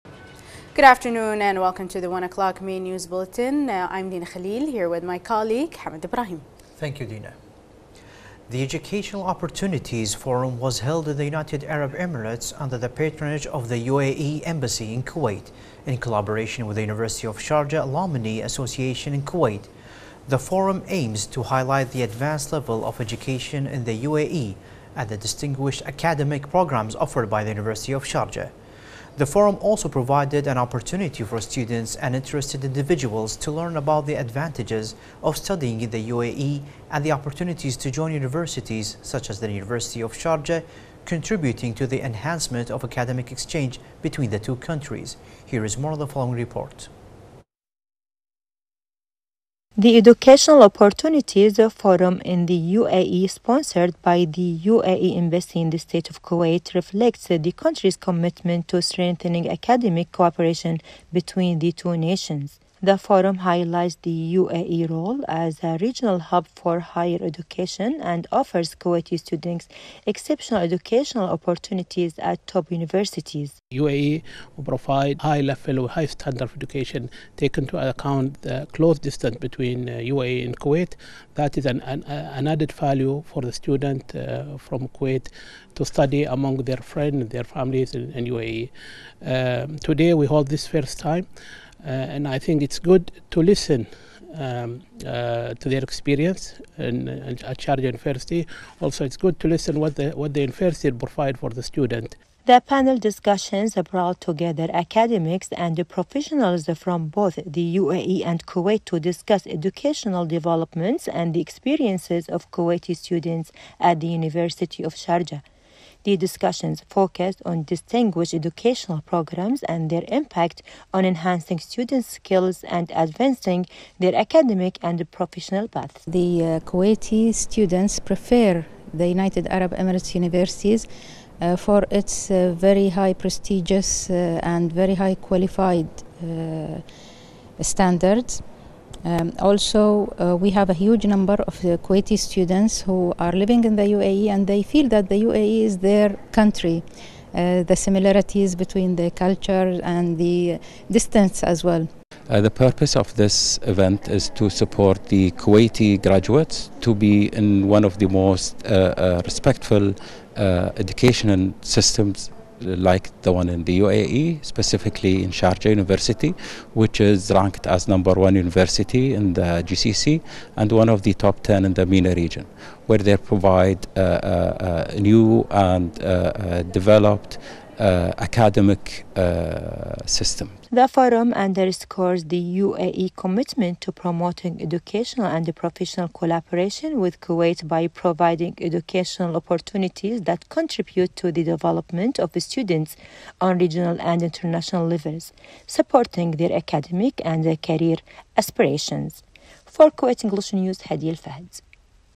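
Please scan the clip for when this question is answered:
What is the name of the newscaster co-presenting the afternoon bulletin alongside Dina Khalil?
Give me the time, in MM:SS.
00:05.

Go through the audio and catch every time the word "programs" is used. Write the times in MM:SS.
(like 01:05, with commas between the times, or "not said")
00:26, 01:59.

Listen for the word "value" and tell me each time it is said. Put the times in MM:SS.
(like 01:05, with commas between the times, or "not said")
01:22.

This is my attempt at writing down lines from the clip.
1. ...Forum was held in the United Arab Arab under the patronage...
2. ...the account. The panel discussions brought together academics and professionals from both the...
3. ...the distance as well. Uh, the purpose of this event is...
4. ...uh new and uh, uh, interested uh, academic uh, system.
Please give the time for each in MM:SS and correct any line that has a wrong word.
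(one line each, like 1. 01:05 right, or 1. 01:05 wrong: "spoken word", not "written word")
1. 00:10 wrong: "Emirates", not "Arab"
2. 01:41 wrong: "student", not "account"
3. 02:30 right
4. 02:54 wrong: "developed", not "interested".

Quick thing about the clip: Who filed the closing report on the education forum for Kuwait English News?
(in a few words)
Hadi El Fahd.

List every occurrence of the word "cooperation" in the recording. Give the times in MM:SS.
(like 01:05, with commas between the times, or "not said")
01:00.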